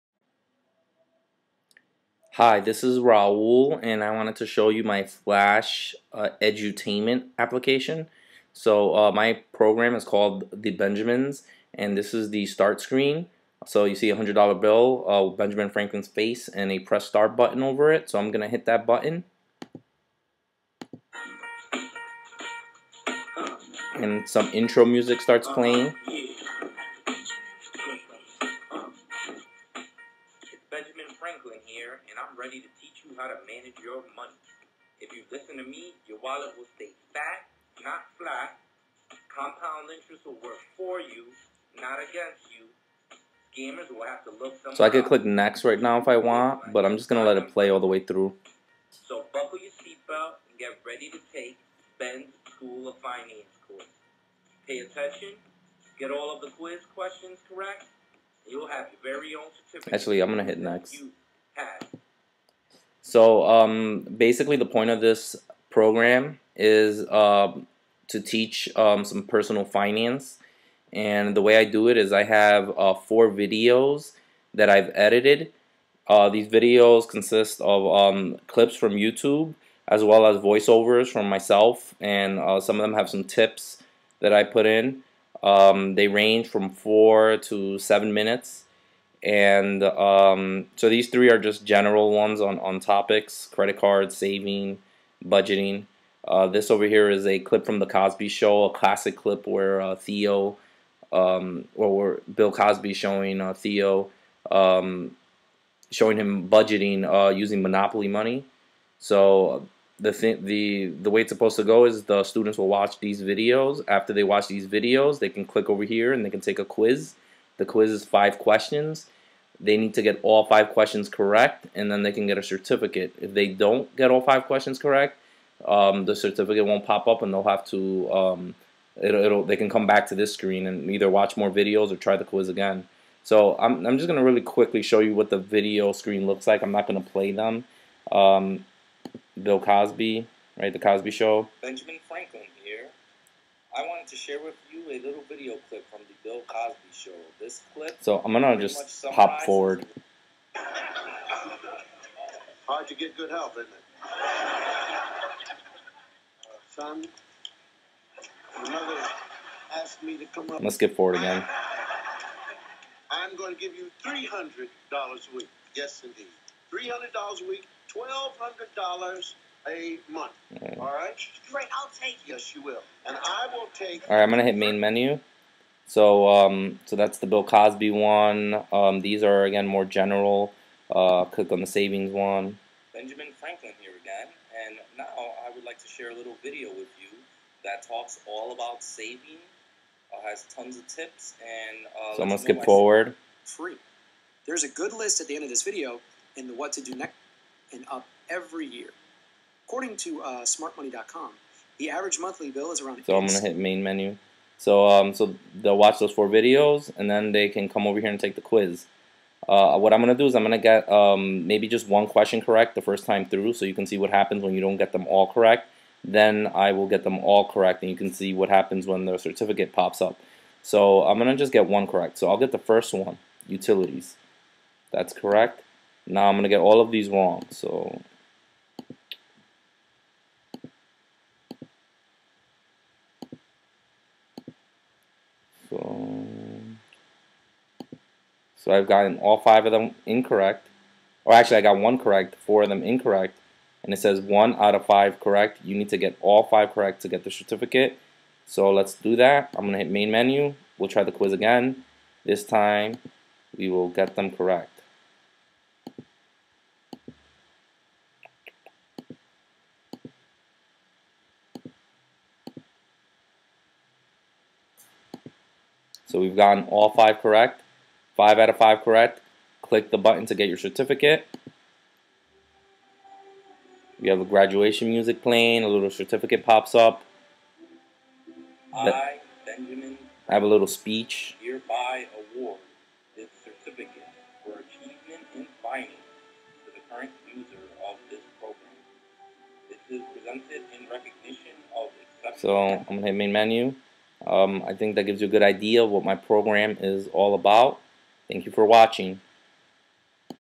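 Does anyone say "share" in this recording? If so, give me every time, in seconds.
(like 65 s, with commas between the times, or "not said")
144 s, 185 s.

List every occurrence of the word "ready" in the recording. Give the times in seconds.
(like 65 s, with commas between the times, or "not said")
32 s, 50 s.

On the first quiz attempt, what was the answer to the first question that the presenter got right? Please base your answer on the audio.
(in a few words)
utilities.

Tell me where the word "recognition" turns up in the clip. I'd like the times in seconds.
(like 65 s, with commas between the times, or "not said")
290 s.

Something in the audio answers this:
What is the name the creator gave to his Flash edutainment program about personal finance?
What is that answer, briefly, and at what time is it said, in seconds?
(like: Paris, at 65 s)
The Benjamins, at 10 s.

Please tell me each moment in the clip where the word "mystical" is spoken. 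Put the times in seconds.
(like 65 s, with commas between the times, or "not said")
not said.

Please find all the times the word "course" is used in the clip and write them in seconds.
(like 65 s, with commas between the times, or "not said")
53 s.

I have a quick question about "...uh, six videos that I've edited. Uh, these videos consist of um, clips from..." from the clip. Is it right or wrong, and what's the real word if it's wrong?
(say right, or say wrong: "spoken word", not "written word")
wrong: "four", not "six".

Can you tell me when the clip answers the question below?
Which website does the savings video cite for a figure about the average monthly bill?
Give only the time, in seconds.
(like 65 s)
200 s.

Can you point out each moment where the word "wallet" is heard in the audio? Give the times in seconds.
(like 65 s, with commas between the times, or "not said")
36 s.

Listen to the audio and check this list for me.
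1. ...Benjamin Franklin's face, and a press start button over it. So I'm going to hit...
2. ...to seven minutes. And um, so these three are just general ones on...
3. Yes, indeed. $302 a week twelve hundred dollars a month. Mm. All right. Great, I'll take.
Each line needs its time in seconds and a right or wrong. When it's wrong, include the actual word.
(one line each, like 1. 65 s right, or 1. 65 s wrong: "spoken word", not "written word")
1. 15 s right
2. 87 s right
3. 165 s wrong: "300", not "302".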